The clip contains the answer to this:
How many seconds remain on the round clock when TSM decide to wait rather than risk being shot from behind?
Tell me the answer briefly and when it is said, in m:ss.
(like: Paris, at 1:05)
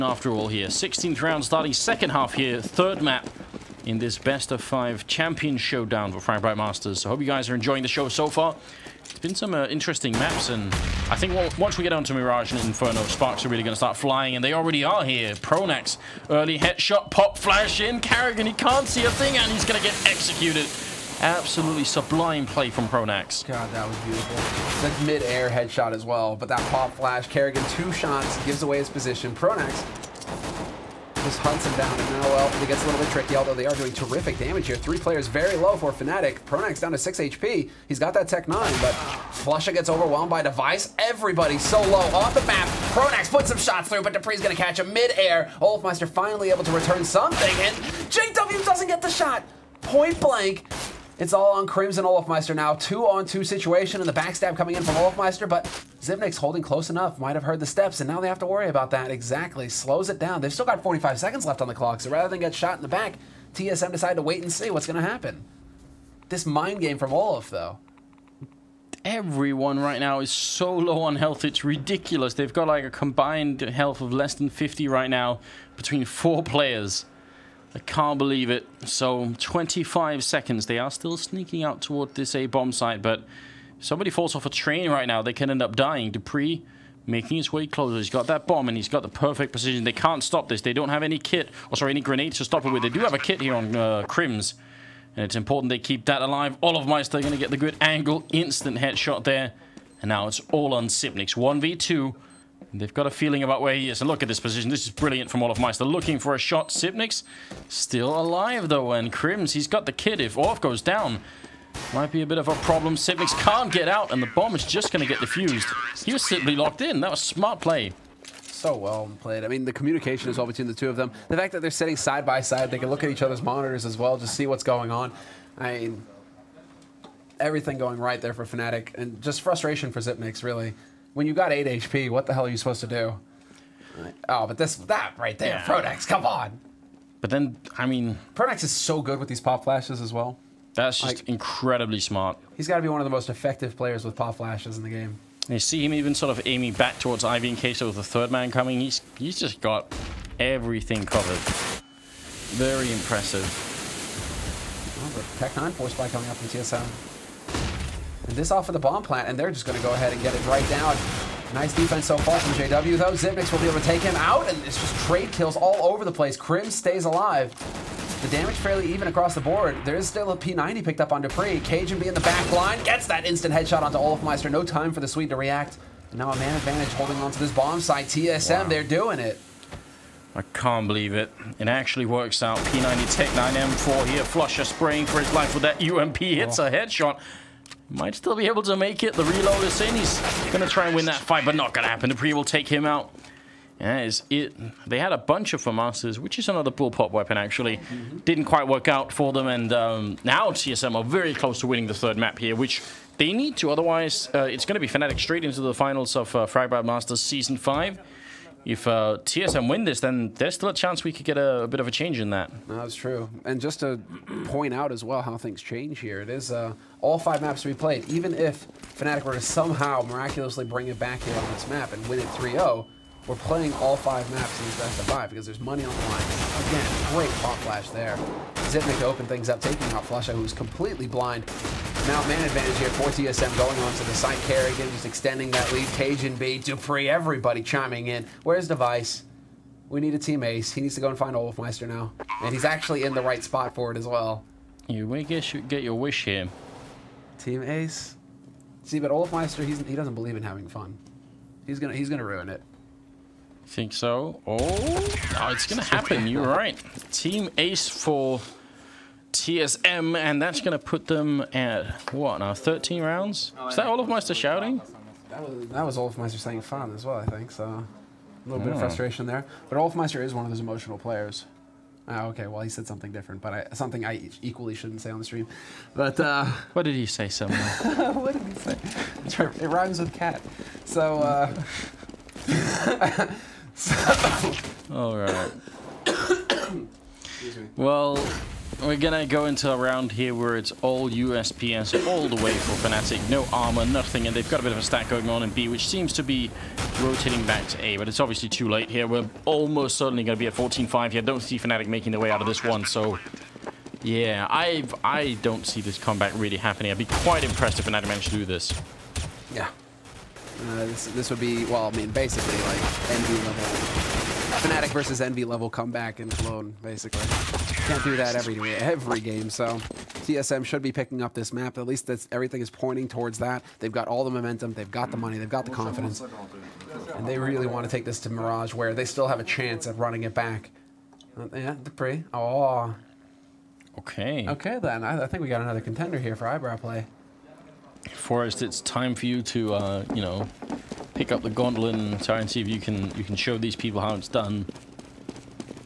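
45, at 1:00.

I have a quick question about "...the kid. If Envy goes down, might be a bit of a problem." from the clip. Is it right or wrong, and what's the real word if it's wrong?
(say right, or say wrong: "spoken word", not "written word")
wrong: "Orf", not "Envy".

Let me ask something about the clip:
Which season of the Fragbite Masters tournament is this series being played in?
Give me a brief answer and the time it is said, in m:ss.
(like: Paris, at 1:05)
Season 5, at 3:27.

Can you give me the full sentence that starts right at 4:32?
Ah, okay, well, he said something different, but I, something I equally shouldn't say on the stream.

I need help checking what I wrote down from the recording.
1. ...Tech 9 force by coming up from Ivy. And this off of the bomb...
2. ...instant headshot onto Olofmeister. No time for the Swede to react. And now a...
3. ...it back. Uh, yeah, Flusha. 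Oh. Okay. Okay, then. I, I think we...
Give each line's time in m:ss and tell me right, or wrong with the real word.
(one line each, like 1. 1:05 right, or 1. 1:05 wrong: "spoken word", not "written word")
1. 2:35 wrong: "TSM", not "Ivy"
2. 2:53 right
3. 5:30 wrong: "Dupree", not "Flusha".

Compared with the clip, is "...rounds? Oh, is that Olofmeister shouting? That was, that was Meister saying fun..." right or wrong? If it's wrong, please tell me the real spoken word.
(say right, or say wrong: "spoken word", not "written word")
right.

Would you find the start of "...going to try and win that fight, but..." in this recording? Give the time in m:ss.
3:10.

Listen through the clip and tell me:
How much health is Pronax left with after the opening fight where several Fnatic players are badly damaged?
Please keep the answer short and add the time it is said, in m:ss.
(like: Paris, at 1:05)
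6 HP, at 0:36.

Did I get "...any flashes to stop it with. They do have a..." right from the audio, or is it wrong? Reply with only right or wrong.
wrong.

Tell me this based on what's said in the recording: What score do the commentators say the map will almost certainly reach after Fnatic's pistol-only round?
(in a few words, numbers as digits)
14-5.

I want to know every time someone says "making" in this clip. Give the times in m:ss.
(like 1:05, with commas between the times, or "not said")
1:27, 5:01.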